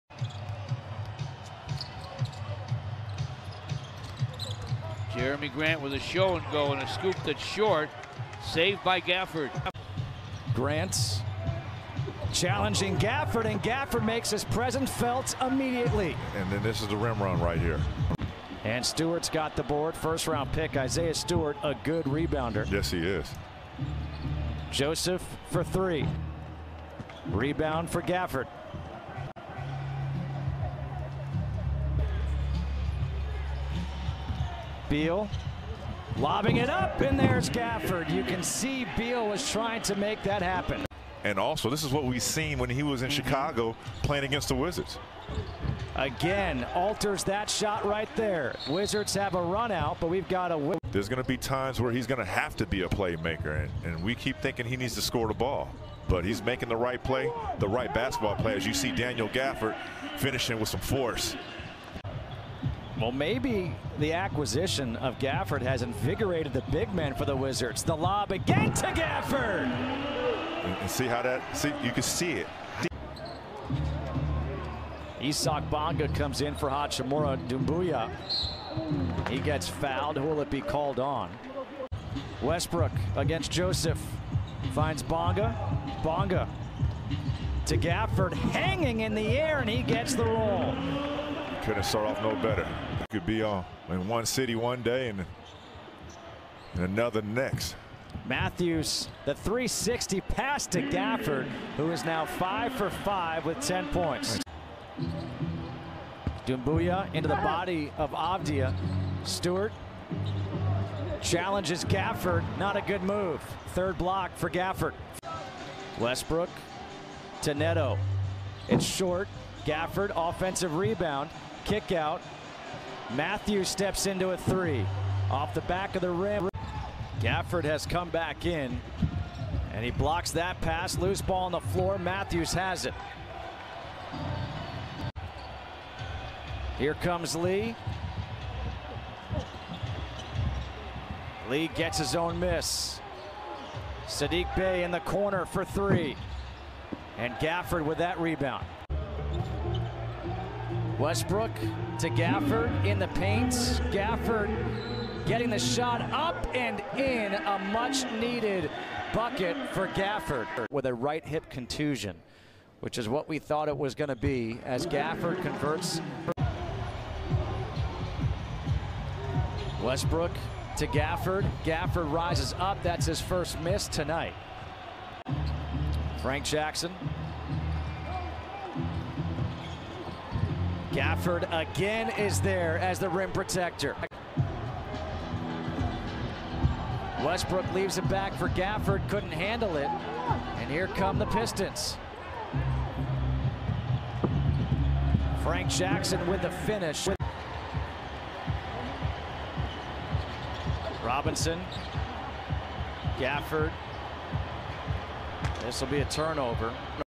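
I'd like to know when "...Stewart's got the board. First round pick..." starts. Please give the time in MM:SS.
00:18.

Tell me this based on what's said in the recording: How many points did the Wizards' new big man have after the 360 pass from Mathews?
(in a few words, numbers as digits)
10.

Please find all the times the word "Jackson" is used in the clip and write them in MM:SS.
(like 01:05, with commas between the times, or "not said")
02:56, 03:15.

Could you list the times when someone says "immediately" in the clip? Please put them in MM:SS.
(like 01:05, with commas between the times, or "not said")
00:15.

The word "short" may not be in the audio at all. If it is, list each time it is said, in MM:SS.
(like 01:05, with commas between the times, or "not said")
00:07, 01:58.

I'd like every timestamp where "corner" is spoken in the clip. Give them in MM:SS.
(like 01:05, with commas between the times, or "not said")
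02:25.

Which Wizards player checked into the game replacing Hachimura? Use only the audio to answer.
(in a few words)
Isaac Bonga.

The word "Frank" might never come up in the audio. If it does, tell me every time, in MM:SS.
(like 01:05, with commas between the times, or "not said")
02:56, 03:15.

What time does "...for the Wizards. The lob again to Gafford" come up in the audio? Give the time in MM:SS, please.
01:07.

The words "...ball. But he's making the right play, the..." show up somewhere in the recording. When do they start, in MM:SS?
00:55.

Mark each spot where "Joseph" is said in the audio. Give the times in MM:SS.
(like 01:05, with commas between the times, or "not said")
00:24, 01:23.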